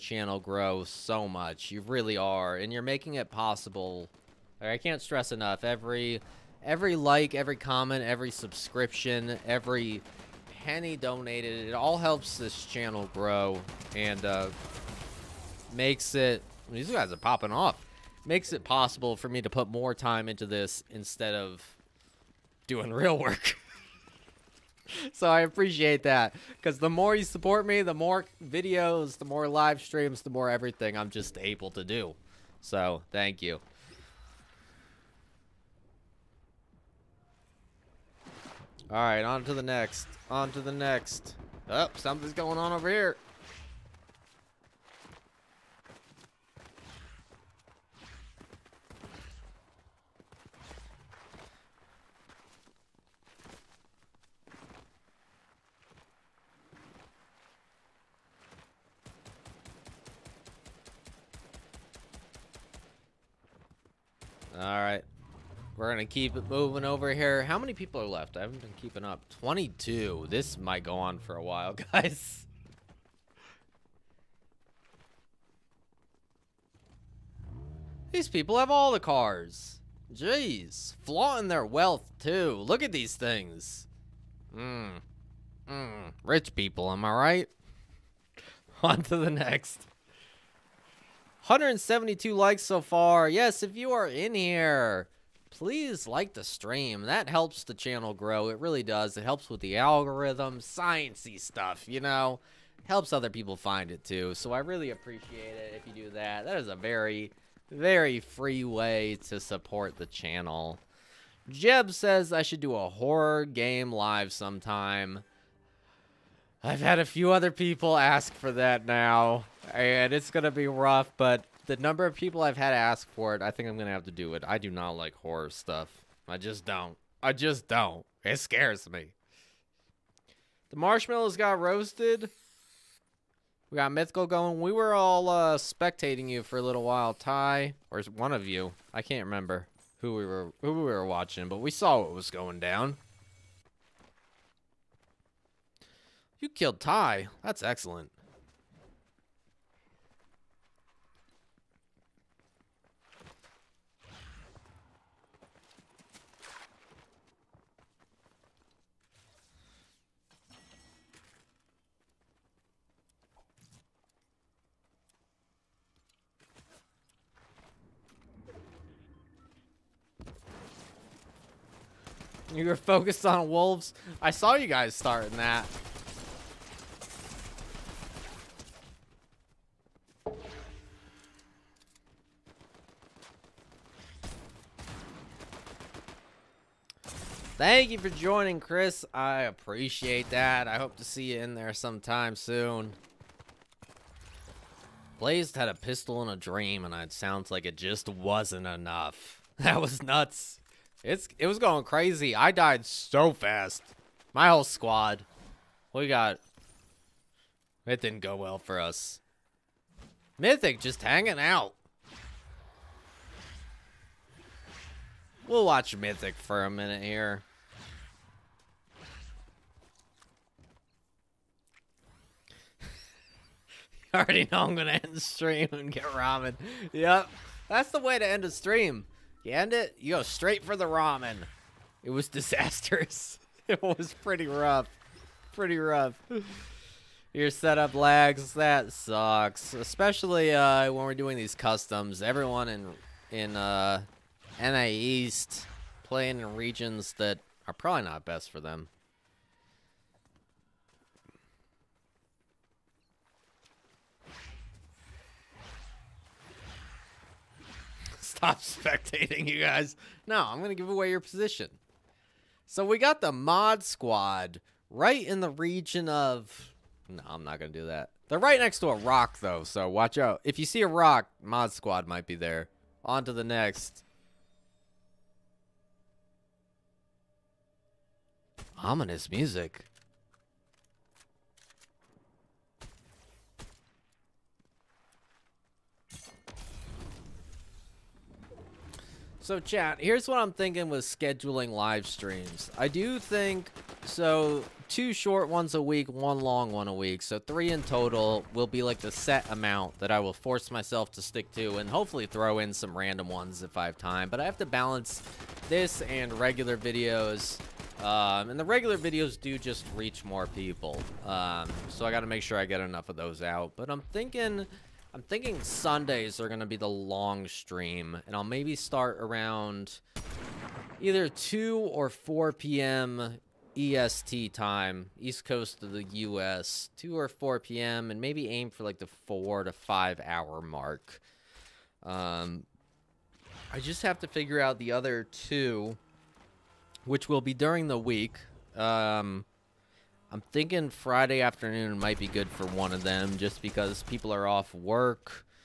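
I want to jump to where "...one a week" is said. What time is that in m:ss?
4:56.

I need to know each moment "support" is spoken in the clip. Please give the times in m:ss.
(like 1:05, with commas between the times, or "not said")
0:27, 1:49.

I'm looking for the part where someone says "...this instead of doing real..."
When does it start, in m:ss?
0:20.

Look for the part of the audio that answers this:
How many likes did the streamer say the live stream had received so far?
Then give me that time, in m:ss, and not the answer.
1:31.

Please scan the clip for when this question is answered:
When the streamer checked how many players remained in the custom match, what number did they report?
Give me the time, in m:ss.
1:09.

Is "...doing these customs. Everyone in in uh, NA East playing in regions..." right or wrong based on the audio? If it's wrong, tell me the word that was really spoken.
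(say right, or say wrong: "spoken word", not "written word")
right.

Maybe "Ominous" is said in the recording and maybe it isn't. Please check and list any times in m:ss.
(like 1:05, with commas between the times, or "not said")
4:38.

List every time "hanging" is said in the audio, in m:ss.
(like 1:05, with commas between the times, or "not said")
3:31.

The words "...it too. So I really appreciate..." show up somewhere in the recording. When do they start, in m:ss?
1:43.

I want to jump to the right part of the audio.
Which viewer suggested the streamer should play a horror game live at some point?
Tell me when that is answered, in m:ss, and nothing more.
1:51.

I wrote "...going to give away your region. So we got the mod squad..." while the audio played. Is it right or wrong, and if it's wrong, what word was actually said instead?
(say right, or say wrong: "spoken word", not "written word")
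wrong: "position", not "region".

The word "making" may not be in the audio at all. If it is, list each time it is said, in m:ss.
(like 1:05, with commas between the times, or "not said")
0:02.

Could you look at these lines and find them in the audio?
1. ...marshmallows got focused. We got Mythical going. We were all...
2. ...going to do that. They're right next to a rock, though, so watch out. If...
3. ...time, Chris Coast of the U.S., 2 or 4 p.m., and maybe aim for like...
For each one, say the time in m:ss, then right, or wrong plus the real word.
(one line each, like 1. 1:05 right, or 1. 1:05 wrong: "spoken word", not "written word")
1. 2:10 wrong: "roasted", not "focused"
2. 4:27 right
3. 5:24 wrong: "East", not "Chris".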